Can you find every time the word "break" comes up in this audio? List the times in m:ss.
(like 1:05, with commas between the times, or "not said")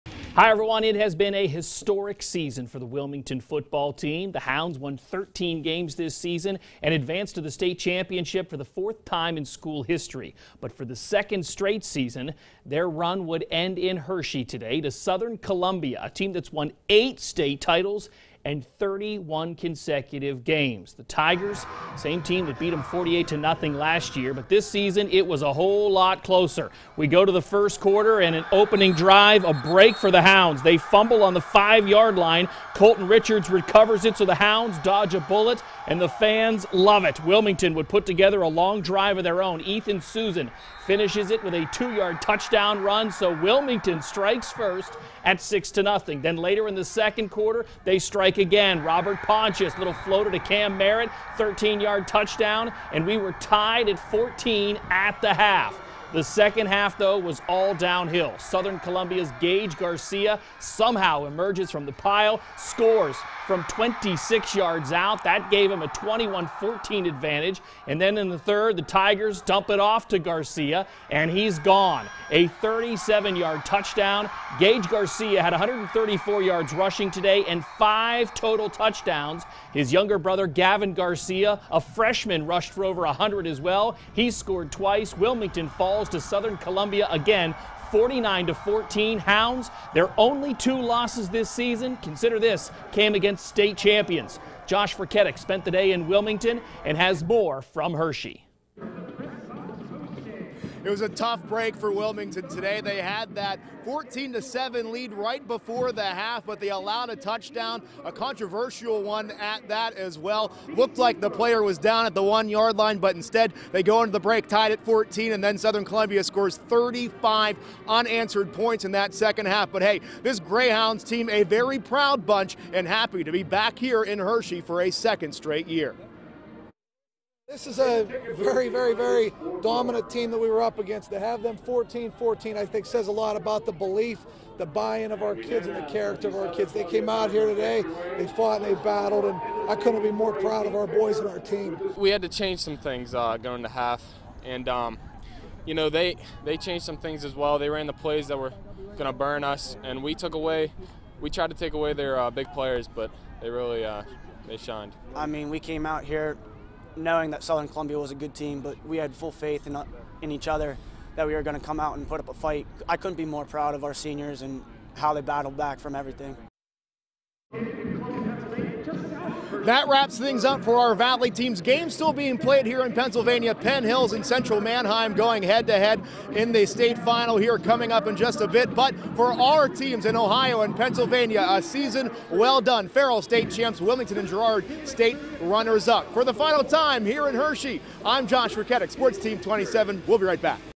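0:29, 1:41, 1:54.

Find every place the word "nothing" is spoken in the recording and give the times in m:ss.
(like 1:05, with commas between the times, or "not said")
0:23, 0:45.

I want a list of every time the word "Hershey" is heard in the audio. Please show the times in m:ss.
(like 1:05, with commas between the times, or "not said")
0:13, 1:37, 2:04, 3:07.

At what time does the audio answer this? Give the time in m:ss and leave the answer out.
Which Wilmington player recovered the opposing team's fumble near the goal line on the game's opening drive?
0:32.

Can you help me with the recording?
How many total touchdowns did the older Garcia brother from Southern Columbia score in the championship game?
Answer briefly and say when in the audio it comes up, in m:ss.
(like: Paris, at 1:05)
5, at 1:17.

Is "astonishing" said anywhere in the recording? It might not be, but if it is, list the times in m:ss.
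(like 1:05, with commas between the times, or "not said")
not said.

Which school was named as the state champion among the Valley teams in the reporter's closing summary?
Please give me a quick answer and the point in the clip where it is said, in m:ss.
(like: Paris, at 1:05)
Farrell, at 3:02.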